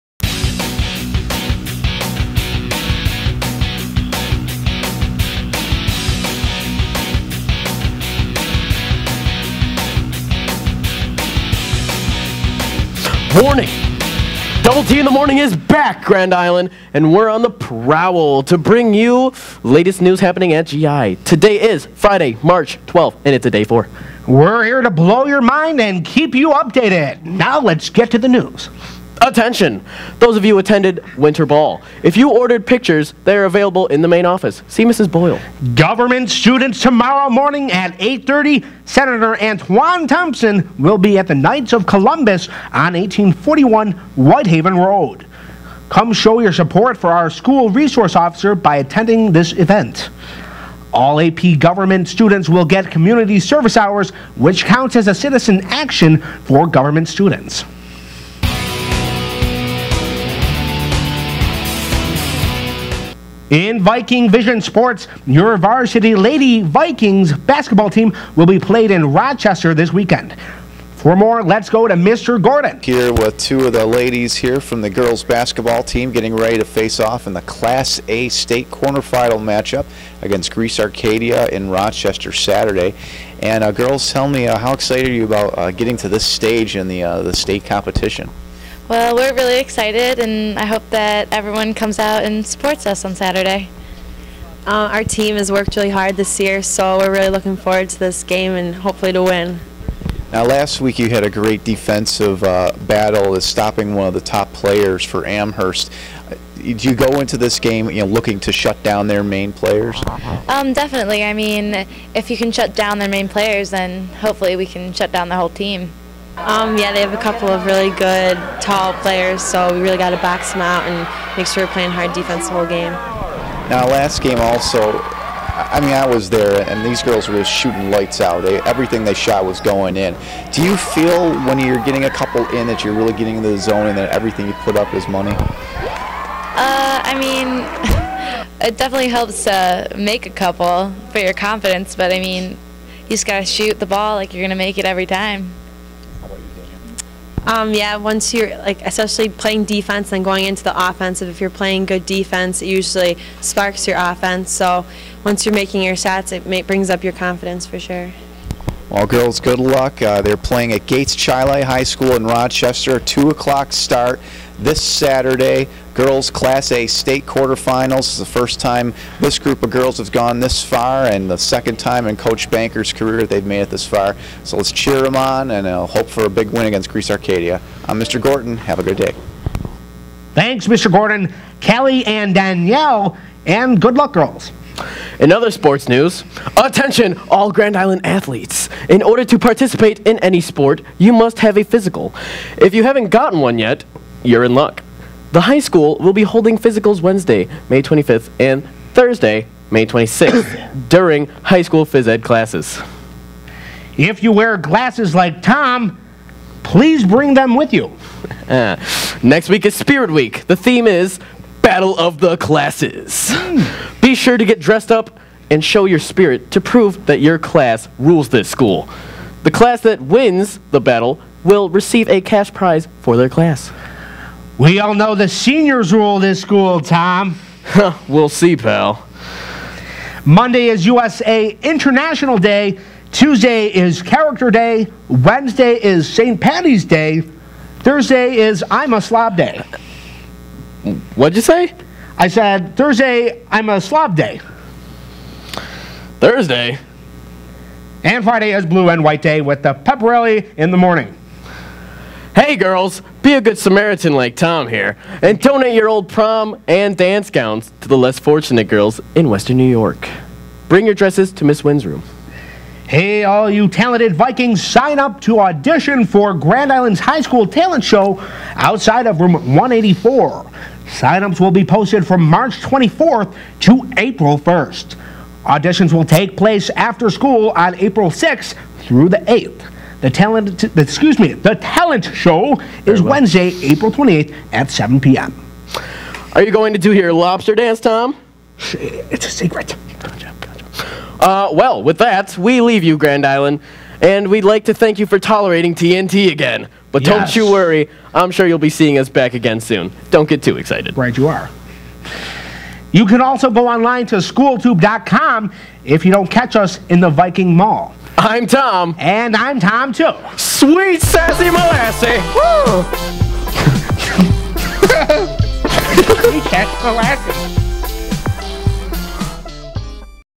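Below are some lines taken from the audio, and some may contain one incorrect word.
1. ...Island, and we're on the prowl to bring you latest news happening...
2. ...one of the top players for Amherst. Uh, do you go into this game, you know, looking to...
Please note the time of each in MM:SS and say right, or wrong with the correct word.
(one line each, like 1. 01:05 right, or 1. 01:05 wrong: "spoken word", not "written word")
1. 00:16 right
2. 01:43 right.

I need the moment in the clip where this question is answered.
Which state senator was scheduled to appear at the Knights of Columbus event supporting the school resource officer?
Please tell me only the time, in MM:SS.
00:39.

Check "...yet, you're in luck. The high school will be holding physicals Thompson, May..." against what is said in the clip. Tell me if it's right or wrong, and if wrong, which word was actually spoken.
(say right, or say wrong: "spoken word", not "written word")
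wrong: "Wednesday", not "Thompson".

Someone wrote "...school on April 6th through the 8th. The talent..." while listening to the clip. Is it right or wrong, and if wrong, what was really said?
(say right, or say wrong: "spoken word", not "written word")
right.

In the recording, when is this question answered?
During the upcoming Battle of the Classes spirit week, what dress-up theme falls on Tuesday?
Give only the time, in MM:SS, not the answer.
03:54.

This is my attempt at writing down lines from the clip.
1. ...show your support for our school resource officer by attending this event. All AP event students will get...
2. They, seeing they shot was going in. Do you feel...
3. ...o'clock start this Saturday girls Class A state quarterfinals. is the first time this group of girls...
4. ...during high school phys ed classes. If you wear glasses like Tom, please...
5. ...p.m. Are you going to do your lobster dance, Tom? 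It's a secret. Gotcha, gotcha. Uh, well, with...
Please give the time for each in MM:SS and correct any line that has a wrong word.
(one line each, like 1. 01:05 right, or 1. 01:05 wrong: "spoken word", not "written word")
1. 00:46 wrong: "government", not "event"
2. 02:08 wrong: "everything", not "seeing"
3. 02:43 right
4. 03:20 right
5. 04:44 right.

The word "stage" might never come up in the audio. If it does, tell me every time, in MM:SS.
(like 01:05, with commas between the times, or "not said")
01:26.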